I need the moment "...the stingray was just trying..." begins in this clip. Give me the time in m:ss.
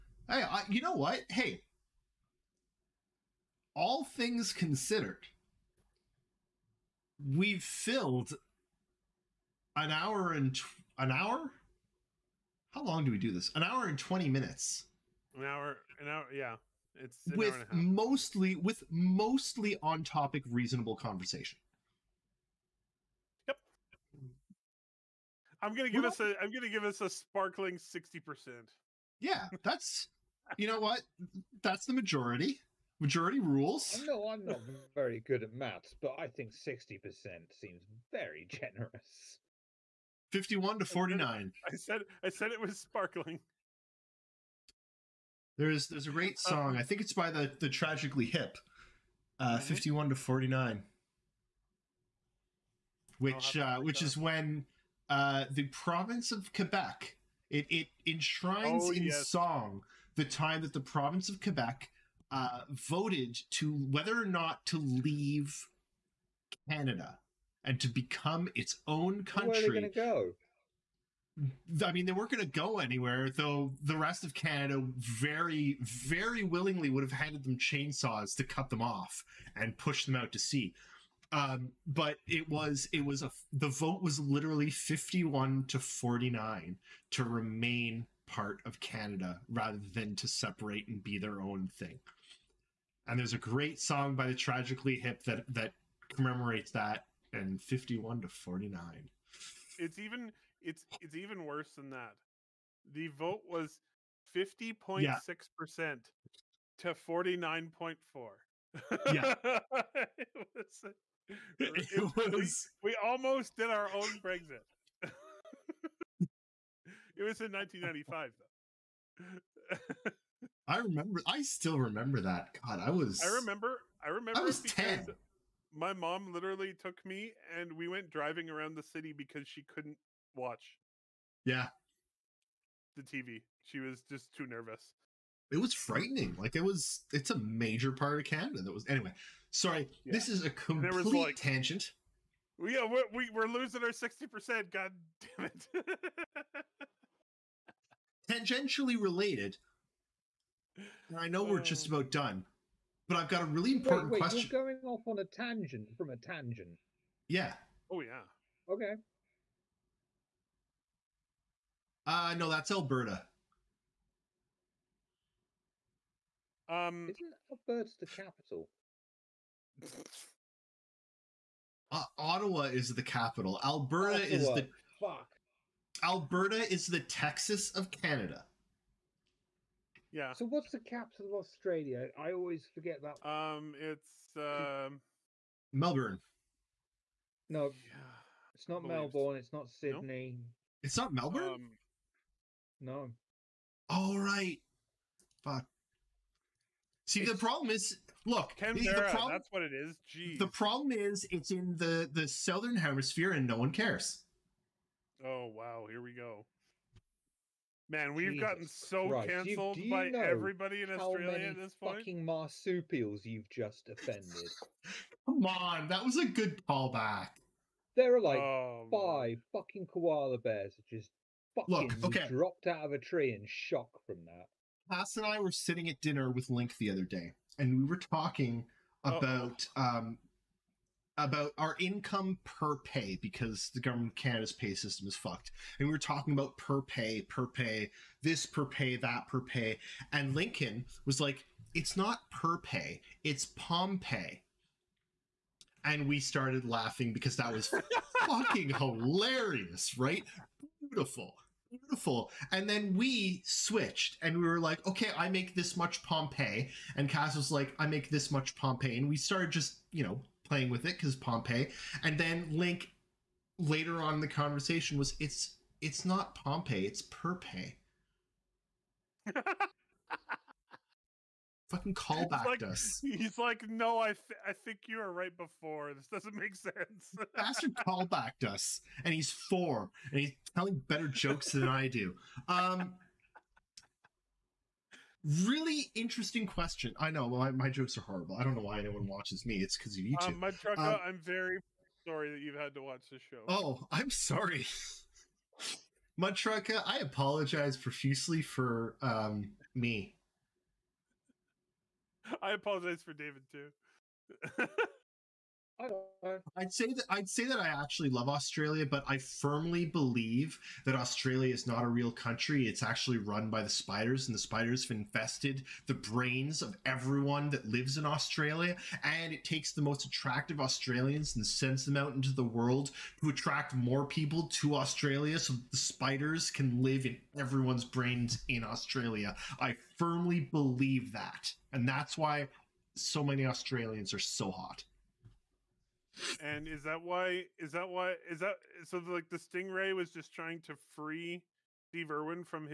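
5:39.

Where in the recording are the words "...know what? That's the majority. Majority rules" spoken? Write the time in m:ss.
0:30.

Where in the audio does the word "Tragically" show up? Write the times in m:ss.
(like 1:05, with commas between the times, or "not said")
0:47, 1:34.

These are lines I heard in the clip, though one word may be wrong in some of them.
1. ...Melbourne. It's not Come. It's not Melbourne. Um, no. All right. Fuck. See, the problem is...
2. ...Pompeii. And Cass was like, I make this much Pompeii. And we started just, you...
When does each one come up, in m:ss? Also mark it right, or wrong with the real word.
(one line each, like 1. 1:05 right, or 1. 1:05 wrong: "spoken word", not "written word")
1. 3:08 wrong: "Sydney", not "Come"
2. 4:16 right.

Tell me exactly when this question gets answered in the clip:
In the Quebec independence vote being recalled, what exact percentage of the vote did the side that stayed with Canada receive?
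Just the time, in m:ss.
1:44.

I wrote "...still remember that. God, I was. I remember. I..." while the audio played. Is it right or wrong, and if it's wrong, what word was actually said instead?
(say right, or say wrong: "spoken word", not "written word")
right.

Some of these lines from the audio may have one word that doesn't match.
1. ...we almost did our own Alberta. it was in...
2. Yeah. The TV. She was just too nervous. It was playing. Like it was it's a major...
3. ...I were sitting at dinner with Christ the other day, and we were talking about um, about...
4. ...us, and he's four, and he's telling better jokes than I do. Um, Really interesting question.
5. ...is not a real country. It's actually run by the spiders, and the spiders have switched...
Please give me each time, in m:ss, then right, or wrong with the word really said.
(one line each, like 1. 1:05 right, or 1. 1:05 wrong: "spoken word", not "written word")
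1. 1:52 wrong: "Brexit", not "Alberta"
2. 2:11 wrong: "frightening", not "playing"
3. 3:45 wrong: "Link", not "Christ"
4. 4:38 right
5. 5:11 wrong: "infested", not "switched".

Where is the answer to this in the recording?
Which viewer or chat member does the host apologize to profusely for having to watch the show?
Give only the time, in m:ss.
4:56.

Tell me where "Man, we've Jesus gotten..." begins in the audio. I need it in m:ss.
3:27.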